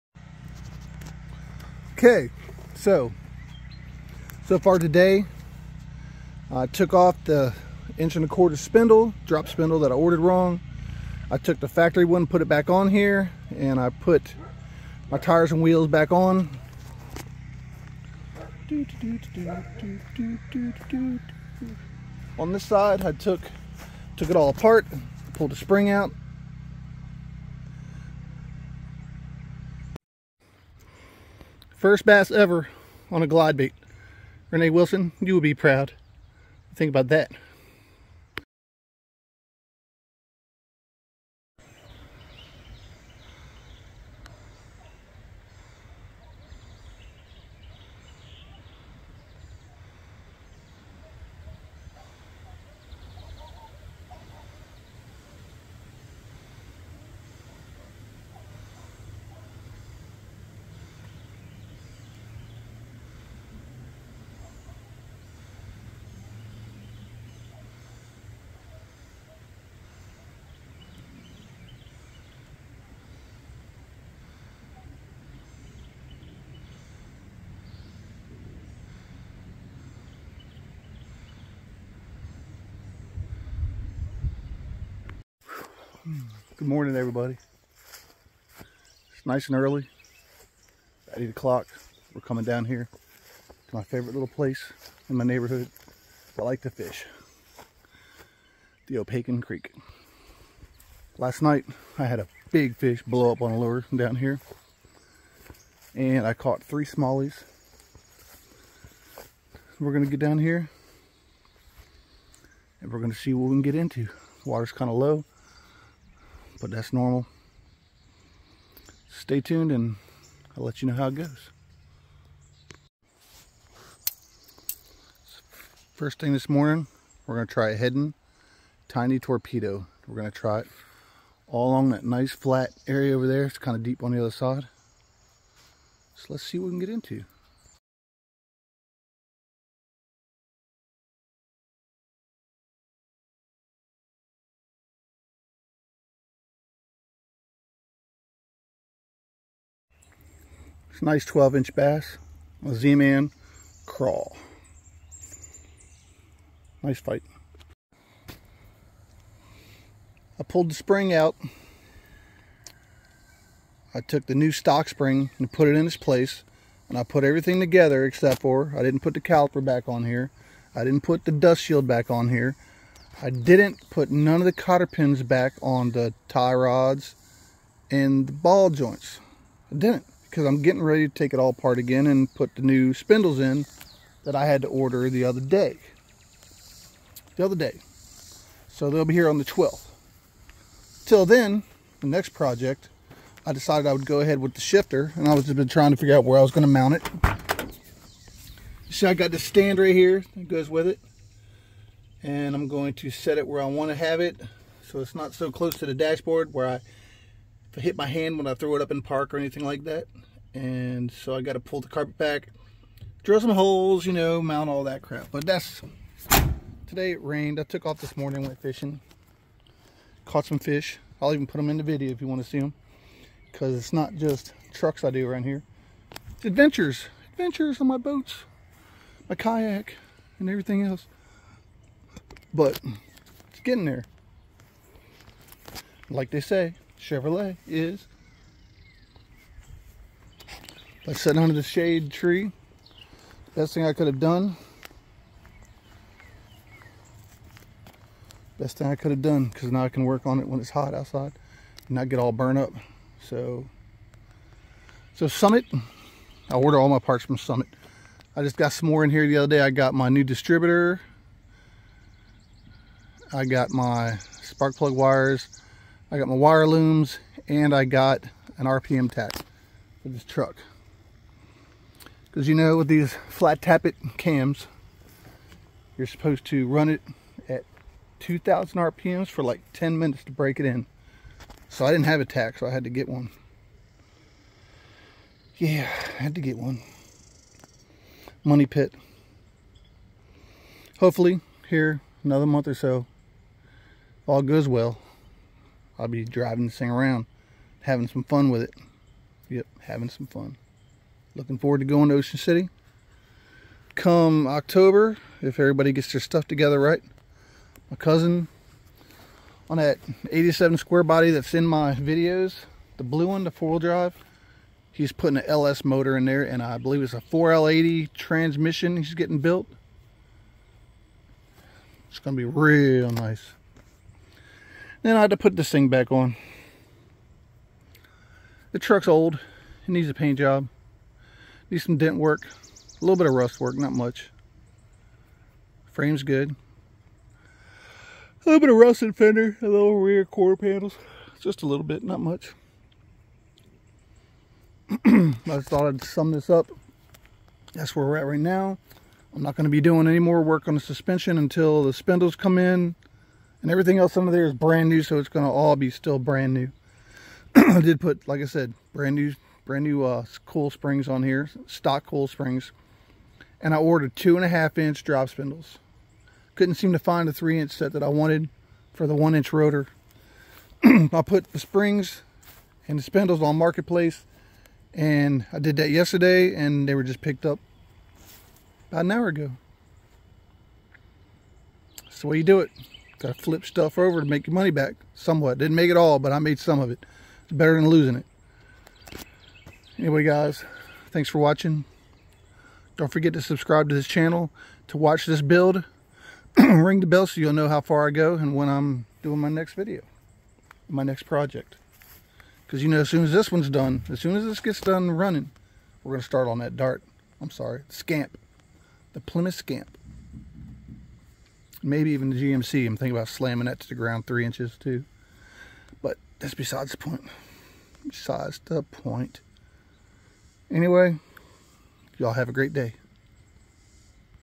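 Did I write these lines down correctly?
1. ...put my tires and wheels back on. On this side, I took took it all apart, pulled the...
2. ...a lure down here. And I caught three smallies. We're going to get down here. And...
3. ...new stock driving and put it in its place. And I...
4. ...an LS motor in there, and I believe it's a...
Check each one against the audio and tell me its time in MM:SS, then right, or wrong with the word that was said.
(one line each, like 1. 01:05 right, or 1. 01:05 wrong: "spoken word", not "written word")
1. 00:13 right
2. 01:43 right
3. 02:44 wrong: "spring", not "driving"
4. 05:15 right.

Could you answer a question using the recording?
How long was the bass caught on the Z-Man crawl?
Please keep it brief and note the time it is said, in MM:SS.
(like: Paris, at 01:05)
12 inch, at 02:31.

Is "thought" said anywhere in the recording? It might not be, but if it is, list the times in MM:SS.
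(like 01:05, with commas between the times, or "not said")
05:45.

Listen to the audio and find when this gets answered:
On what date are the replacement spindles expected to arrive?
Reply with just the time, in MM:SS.
03:09.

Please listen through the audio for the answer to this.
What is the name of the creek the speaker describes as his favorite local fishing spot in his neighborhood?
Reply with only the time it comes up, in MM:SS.
01:38.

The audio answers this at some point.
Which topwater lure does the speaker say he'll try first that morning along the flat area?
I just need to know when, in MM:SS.
02:07.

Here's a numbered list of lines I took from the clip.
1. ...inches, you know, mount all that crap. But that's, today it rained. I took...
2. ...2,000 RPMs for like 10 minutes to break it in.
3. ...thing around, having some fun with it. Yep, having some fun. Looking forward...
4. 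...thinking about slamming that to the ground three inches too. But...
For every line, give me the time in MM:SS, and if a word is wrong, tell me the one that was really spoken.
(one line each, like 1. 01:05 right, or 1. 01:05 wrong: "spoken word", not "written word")
1. 03:33 wrong: "holes", not "inches"
2. 04:38 right
3. 04:56 right
4. 06:52 right.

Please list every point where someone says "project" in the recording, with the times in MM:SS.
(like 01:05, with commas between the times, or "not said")
03:12, 06:41.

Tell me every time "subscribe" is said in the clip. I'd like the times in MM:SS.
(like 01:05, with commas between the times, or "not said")
06:33.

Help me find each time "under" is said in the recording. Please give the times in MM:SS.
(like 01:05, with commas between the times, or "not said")
04:01, 05:54.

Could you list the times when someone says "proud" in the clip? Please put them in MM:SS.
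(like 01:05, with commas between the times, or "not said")
00:35.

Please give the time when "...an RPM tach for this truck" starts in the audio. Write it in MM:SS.
04:28.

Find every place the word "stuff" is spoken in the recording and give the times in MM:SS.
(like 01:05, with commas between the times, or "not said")
05:06, 06:23.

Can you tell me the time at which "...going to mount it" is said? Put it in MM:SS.
03:16.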